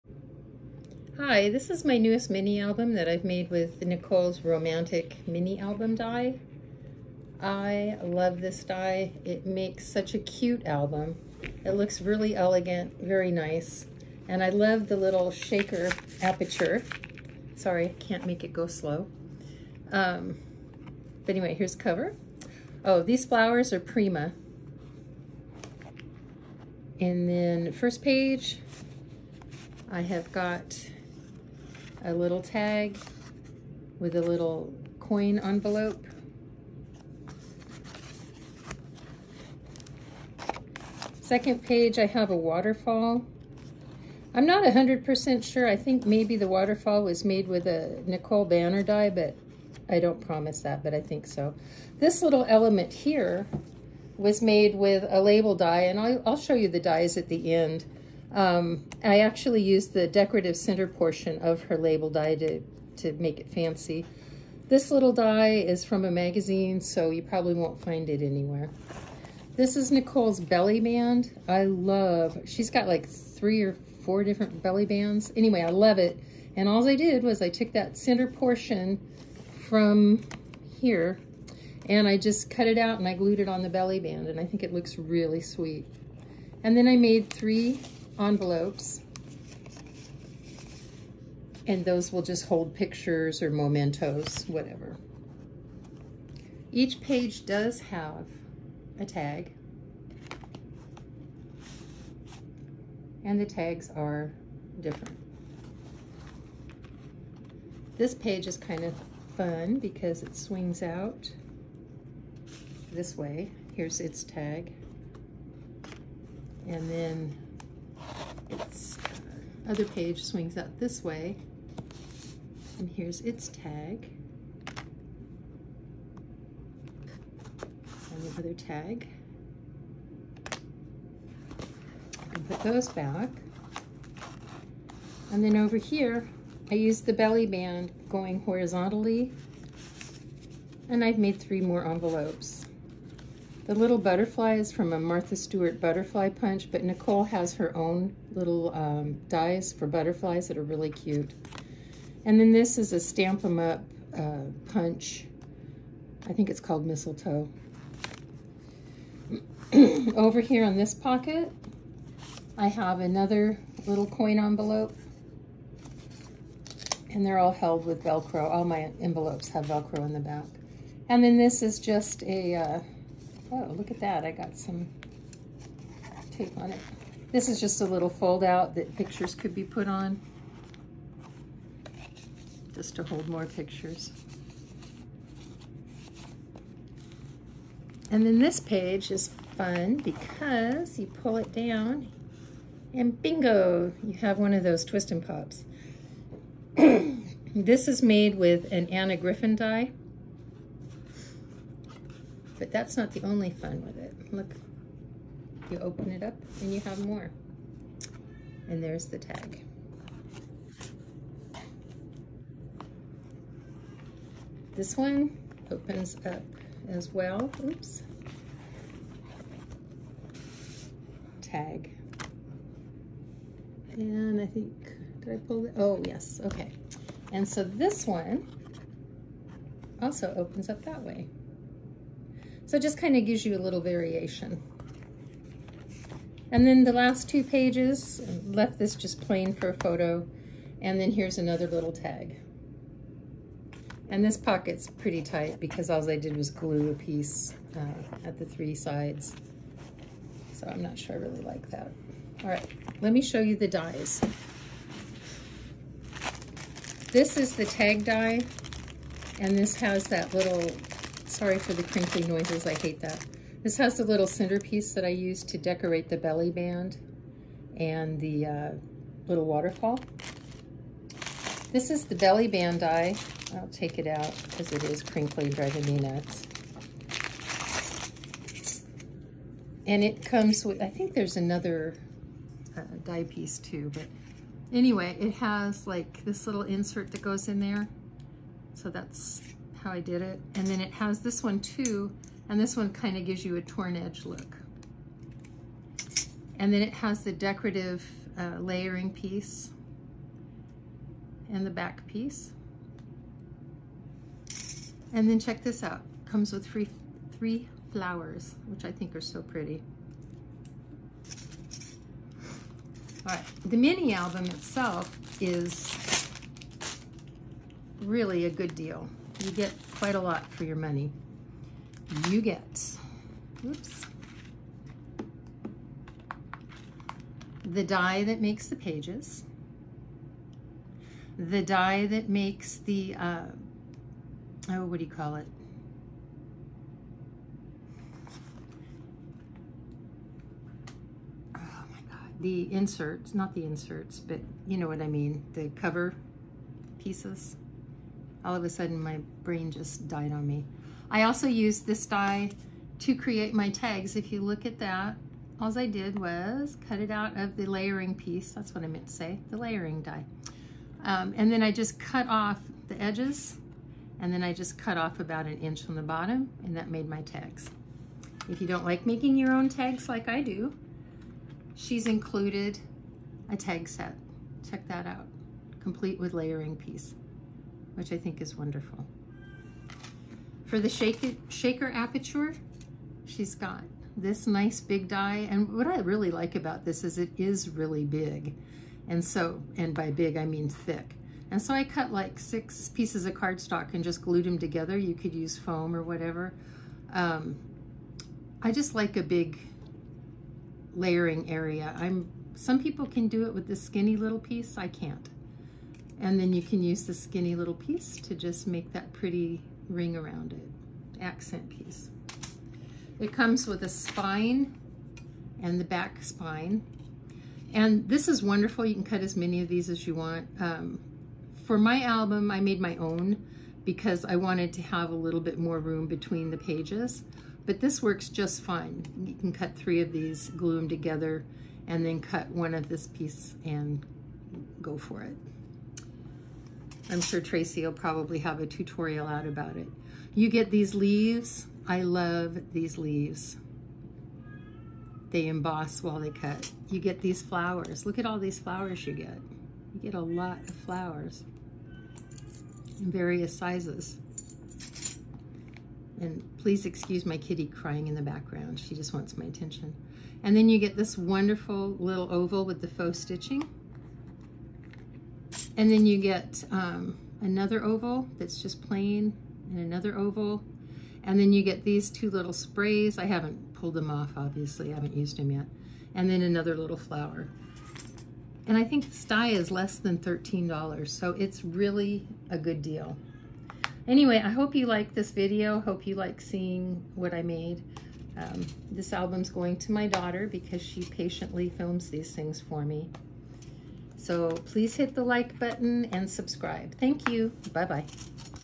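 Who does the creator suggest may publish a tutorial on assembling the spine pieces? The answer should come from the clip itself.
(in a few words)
Tracy.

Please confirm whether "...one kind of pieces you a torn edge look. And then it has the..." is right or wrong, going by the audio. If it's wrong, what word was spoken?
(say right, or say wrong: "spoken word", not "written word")
wrong: "gives", not "pieces".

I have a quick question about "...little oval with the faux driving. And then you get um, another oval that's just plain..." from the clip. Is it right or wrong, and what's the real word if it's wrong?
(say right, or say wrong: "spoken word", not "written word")
wrong: "stitching", not "driving".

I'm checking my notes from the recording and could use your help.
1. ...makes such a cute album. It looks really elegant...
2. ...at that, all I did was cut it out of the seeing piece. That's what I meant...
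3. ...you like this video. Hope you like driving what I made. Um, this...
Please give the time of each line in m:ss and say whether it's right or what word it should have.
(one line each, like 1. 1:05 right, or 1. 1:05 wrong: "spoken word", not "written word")
1. 0:09 right
2. 5:54 wrong: "layering", not "seeing"
3. 8:04 wrong: "seeing", not "driving".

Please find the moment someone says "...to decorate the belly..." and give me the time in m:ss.
4:25.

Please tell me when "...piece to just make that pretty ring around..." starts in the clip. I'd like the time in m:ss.
6:47.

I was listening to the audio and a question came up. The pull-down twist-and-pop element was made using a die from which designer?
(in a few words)
Anna Griffin.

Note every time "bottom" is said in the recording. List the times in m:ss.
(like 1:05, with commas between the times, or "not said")
6:06.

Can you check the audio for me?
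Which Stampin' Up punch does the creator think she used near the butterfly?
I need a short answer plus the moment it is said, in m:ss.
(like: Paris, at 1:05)
mistletoe, at 2:36.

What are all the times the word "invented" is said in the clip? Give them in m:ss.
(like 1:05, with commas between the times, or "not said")
not said.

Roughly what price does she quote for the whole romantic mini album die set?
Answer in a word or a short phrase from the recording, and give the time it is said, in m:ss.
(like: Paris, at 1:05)
less than $13, at 7:59.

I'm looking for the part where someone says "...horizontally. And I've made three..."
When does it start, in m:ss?
2:18.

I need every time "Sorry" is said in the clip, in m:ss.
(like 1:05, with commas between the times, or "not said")
0:17, 4:21.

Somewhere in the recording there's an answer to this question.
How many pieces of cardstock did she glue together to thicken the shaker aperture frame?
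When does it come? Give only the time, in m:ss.
6:32.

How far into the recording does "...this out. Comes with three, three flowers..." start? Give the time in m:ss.
5:05.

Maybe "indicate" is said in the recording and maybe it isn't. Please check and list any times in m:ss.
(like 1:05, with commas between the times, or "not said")
not said.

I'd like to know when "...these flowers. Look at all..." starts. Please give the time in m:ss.
7:27.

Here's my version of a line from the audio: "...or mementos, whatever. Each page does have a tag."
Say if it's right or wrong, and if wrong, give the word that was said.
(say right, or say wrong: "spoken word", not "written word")
right.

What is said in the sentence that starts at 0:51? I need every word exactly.
This little element here was made with a label die, and I'll, I'll show you the dies at the end.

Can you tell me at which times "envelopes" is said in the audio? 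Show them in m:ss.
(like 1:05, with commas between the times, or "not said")
0:35, 1:28, 2:21, 2:44, 2:48.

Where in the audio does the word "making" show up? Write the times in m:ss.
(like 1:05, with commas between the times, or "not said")
6:09.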